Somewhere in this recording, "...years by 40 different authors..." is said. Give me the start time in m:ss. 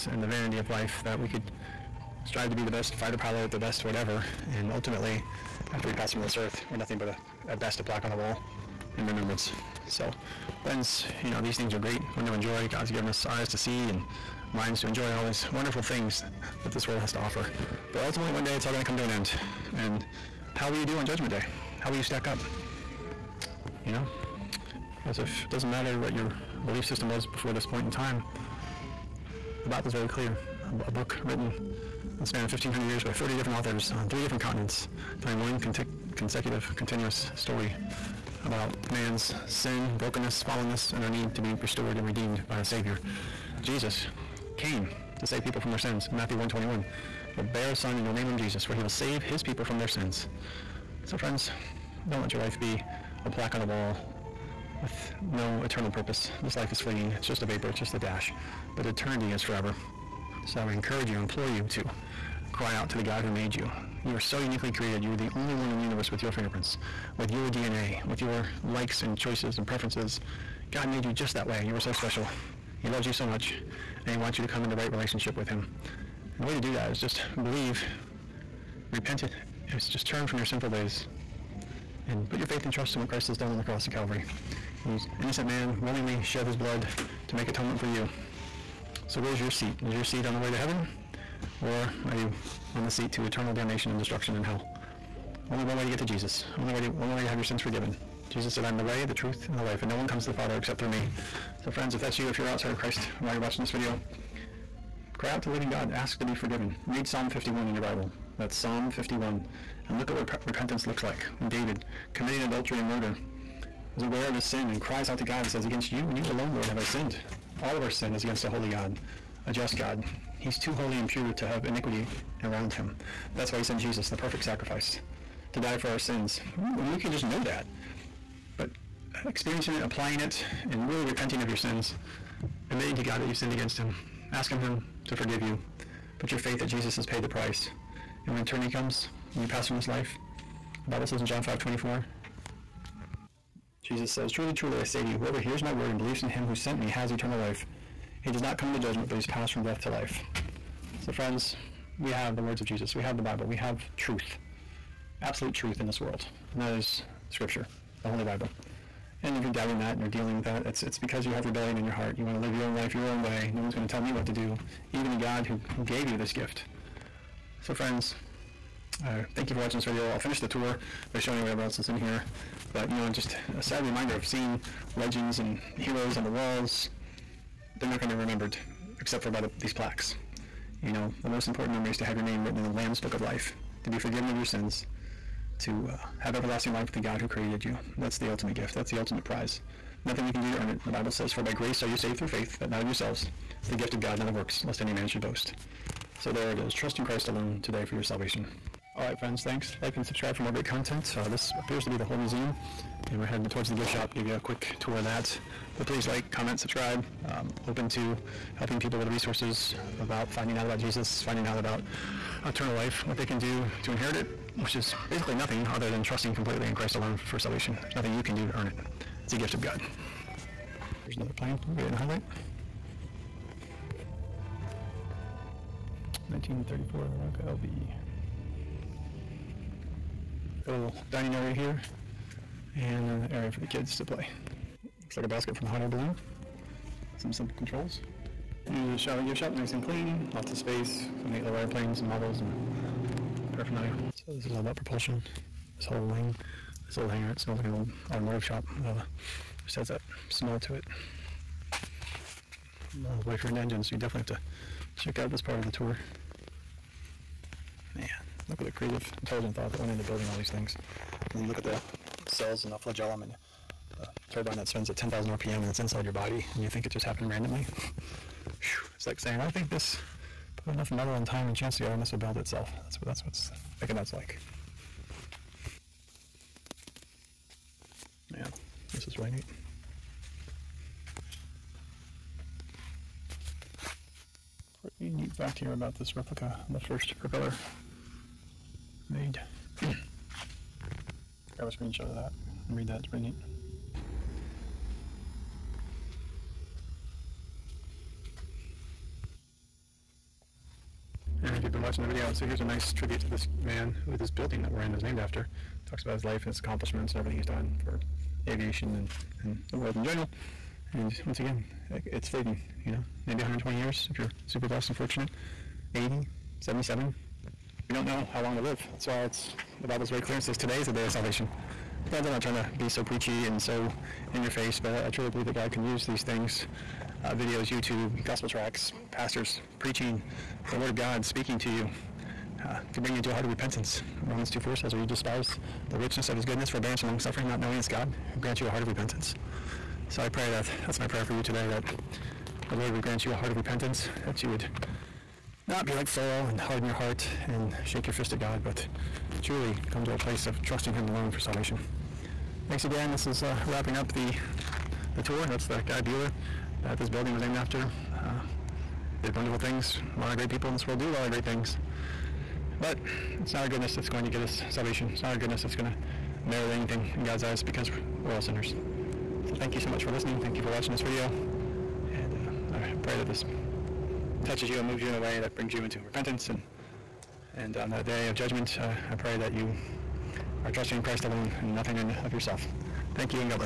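0:32.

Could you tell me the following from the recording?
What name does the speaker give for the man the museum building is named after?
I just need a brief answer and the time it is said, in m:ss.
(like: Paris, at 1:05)
Bueller, at 5:56.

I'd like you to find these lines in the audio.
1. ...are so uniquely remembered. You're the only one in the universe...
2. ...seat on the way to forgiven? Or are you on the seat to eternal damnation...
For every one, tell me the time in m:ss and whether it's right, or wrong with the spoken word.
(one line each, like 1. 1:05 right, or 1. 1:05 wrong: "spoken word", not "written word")
1. 1:04 wrong: "created", not "remembered"
2. 1:30 wrong: "heaven", not "forgiven".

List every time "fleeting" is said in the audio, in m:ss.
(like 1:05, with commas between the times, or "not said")
0:56, 5:12.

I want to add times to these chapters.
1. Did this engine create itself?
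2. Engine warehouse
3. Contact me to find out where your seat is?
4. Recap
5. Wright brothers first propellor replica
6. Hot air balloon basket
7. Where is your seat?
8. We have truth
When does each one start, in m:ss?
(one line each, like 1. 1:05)
1. 4:20
2. 4:10
3. 3:35
4. 5:22
5. 4:51
6. 3:55
7. 1:26
8. 2:36.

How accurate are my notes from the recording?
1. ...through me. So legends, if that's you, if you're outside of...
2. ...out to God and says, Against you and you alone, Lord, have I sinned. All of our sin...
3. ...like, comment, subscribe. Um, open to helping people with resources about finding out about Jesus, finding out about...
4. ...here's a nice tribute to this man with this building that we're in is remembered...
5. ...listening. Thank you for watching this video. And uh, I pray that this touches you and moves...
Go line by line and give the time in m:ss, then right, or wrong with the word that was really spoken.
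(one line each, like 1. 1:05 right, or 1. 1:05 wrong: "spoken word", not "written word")
1. 1:40 wrong: "friends", not "legends"
2. 1:55 right
3. 3:26 right
4. 5:02 wrong: "named", not "remembered"
5. 6:10 right.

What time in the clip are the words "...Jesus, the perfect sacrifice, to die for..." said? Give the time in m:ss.
2:03.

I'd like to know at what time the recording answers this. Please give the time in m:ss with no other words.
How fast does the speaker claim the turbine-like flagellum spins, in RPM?
4:24.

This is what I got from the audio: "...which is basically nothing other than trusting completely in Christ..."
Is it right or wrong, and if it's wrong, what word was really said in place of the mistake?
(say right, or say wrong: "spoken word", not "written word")
right.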